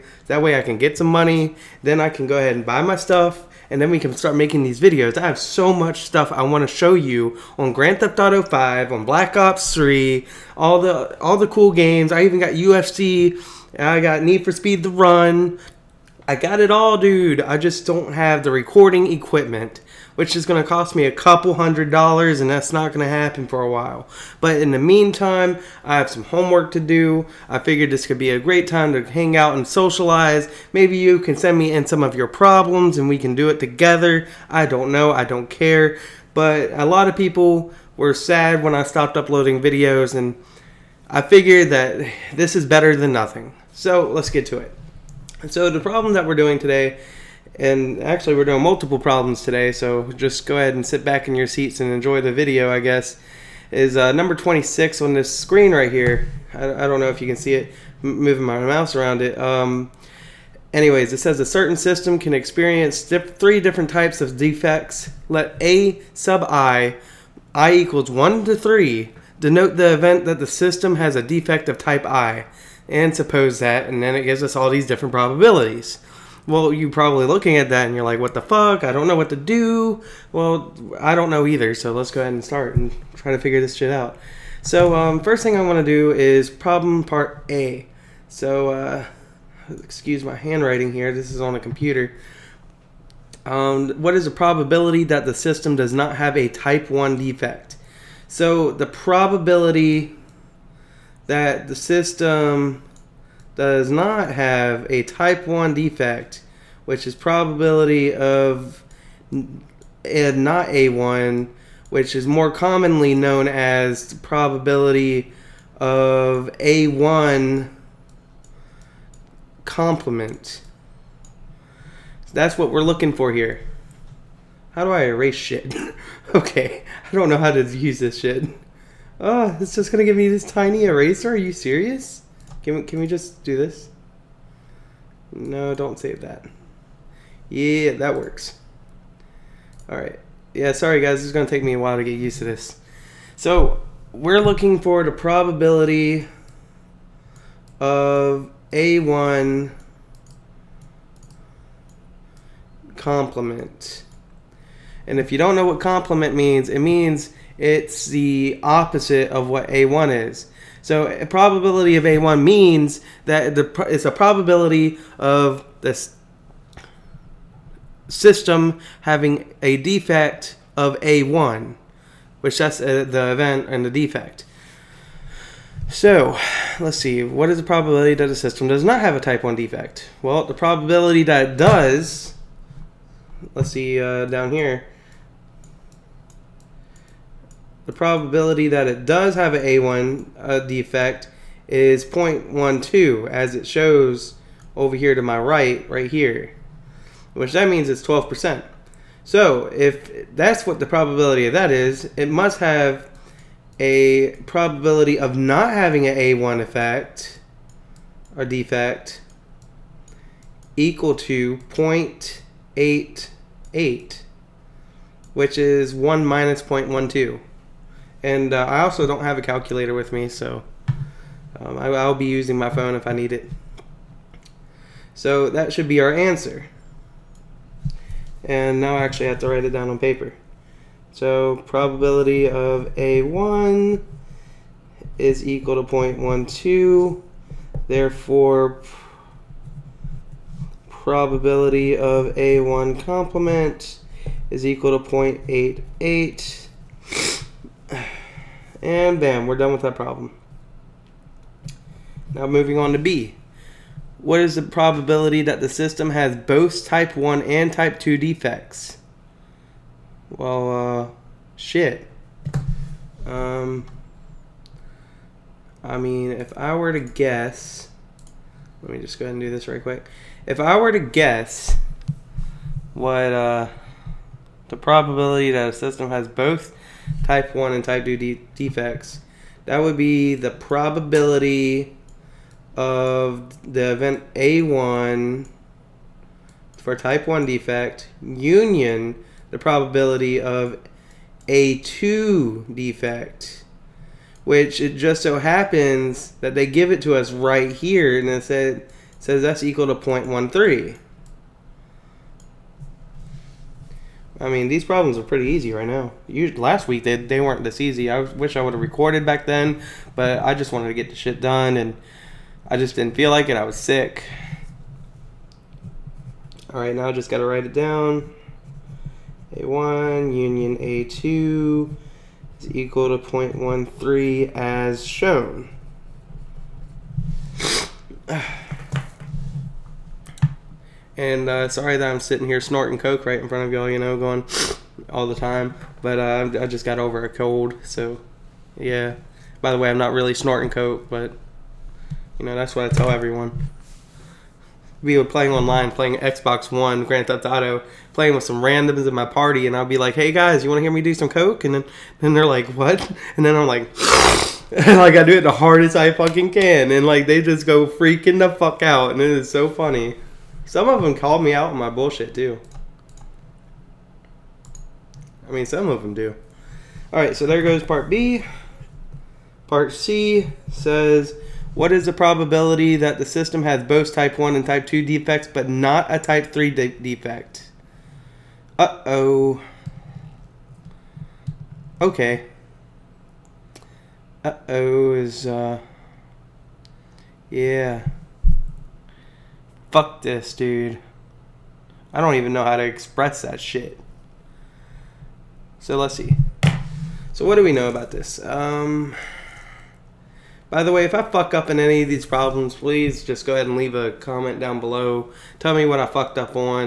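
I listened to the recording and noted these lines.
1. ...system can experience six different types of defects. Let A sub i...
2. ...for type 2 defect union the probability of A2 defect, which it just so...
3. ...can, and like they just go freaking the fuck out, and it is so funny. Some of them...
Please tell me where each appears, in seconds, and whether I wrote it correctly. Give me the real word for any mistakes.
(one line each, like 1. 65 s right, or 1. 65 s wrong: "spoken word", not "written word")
1. 61 s wrong: "three", not "six"
2. 286 s wrong: "1", not "2"
3. 356 s right.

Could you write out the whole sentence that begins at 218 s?
And uh, I also don't have a calculator with me, so um, I, I'll be using my phone if I need it.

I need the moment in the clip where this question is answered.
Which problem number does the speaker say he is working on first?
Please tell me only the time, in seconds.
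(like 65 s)
54 s.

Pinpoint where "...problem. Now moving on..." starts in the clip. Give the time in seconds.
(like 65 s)
249 s.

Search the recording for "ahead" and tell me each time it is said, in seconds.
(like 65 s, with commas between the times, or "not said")
2 s, 50 s, 82 s, 269 s, 403 s.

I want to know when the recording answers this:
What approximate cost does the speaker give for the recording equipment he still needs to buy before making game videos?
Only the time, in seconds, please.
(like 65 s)
21 s.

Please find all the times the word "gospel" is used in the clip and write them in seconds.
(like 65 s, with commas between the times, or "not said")
not said.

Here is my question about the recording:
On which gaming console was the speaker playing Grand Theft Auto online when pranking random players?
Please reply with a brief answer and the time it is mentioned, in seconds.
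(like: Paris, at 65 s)
Xbox One, at 346 s.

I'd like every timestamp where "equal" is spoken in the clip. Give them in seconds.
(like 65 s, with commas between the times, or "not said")
67 s, 210 s, 235 s, 244 s, 299 s, 322 s.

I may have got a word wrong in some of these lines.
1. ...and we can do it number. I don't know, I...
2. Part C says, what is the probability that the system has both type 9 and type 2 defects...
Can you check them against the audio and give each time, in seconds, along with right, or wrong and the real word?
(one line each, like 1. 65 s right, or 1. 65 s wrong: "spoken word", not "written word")
1. 32 s wrong: "together", not "number"
2. 369 s wrong: "1", not "9".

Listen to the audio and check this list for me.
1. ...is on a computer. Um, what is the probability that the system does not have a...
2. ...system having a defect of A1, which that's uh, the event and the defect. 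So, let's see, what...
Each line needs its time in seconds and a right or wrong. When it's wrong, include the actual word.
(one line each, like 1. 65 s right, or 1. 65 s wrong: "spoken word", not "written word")
1. 91 s right
2. 168 s right.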